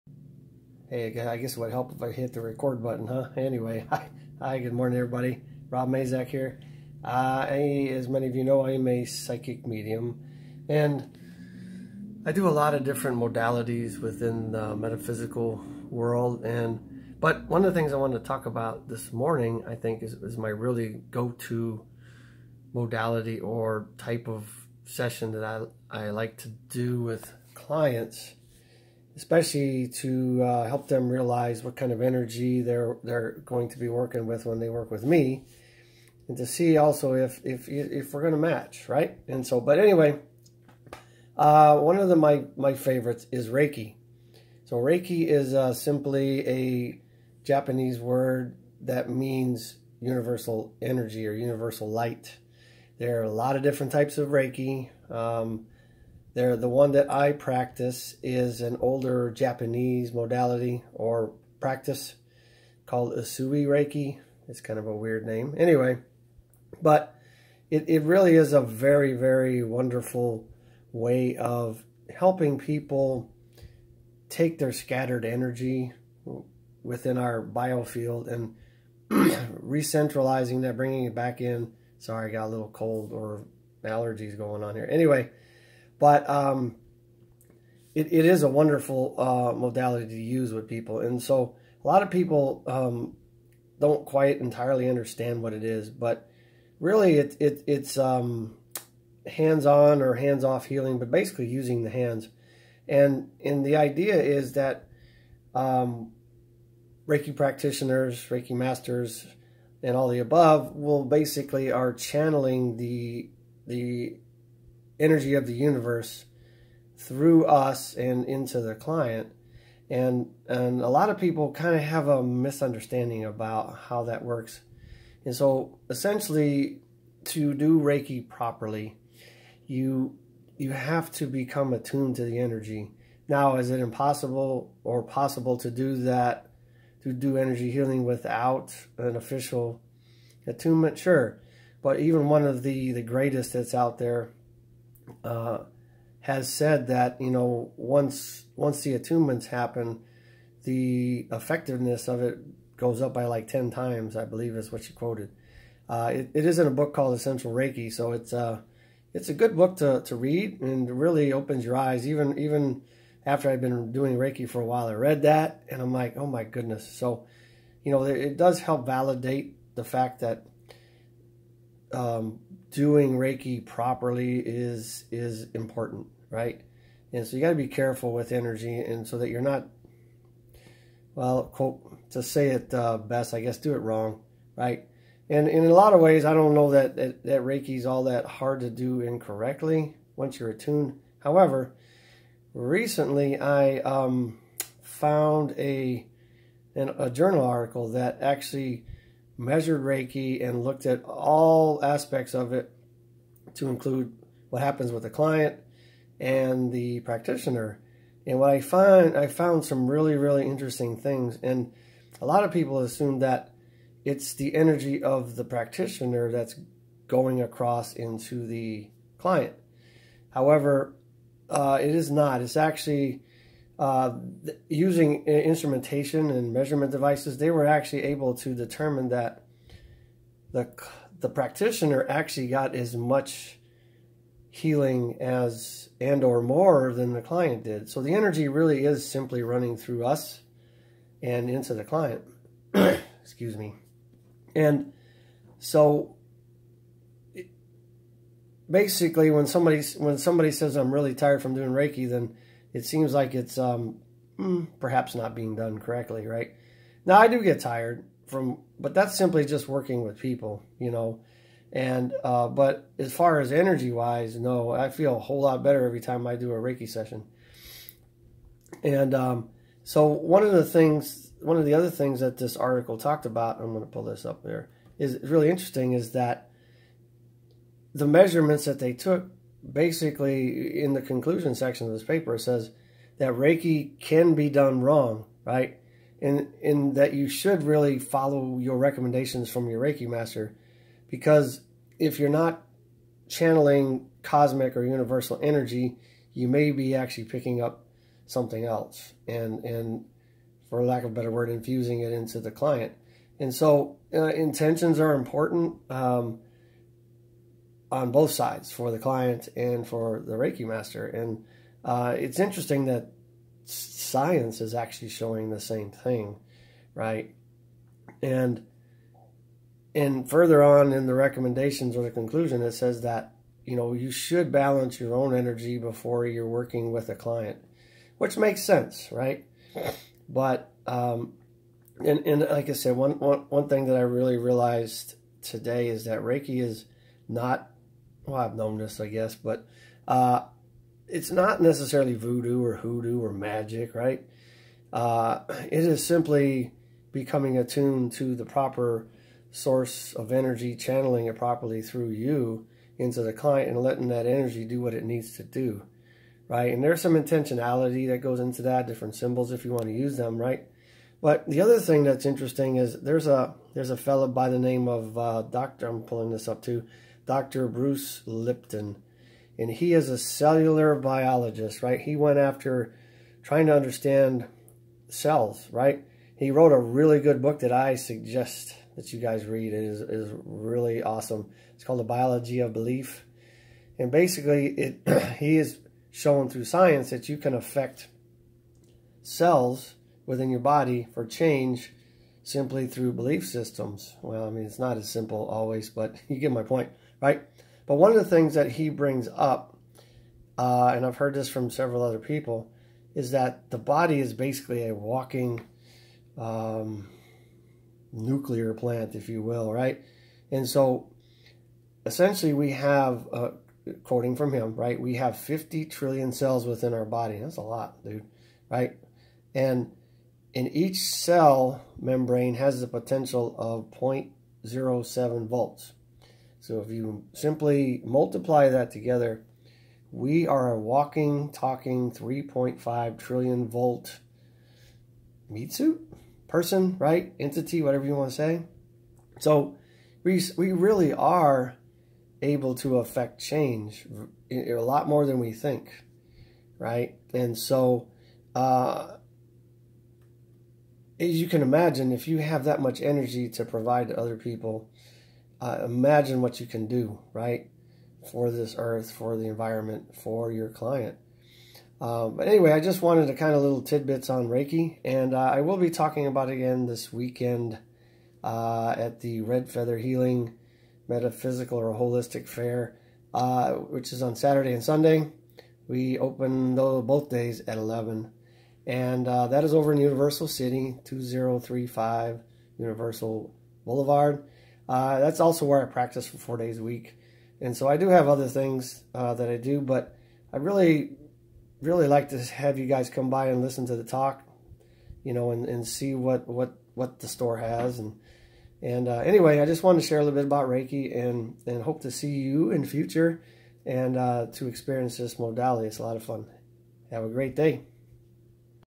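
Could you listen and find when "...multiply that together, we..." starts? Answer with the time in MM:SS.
07:08.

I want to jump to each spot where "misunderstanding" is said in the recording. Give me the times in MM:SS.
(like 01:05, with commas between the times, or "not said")
02:02.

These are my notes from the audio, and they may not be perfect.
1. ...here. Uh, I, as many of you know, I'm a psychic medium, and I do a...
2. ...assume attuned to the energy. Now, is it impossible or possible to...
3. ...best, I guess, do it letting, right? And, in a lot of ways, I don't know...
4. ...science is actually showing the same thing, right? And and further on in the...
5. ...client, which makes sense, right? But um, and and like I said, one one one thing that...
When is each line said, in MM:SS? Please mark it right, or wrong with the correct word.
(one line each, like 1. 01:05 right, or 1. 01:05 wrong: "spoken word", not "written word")
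1. 00:06 right
2. 02:11 wrong: "become", not "assume"
3. 03:02 wrong: "wrong", not "letting"
4. 05:13 right
5. 05:27 right.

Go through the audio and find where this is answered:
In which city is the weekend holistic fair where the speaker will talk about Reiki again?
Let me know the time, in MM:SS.
07:59.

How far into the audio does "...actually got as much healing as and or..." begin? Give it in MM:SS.
03:52.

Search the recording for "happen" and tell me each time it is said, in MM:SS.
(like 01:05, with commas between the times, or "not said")
02:29, 03:24.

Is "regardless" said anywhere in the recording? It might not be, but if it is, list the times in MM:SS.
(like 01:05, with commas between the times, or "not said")
not said.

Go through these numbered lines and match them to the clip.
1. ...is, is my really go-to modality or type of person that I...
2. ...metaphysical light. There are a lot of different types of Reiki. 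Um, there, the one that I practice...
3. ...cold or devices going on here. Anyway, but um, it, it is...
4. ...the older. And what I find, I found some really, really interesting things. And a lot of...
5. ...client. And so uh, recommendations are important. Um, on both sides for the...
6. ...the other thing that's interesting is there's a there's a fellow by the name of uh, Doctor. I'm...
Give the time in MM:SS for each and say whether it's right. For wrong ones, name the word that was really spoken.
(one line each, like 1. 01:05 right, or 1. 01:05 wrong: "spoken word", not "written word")
1. 00:20 wrong: "session", not "person"
2. 00:51 wrong: "universal", not "metaphysical"
3. 01:22 wrong: "allergies", not "devices"
4. 03:26 wrong: "practitioner", not "older"
5. 05:02 wrong: "intentions", not "recommendations"
6. 06:01 right.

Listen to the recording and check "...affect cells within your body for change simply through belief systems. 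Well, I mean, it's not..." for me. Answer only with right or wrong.
right.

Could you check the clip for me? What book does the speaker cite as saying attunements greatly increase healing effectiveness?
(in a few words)
Essential Reiki.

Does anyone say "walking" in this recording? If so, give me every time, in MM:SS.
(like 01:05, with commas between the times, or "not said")
06:44, 07:10.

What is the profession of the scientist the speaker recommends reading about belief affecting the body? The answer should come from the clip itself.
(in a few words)
cellular biologist.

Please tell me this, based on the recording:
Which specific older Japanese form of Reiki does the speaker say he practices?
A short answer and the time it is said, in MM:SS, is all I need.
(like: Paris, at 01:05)
Usui Reiki, at 01:03.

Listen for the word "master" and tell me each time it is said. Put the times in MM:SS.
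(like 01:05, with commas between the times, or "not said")
01:48, 04:50, 05:10.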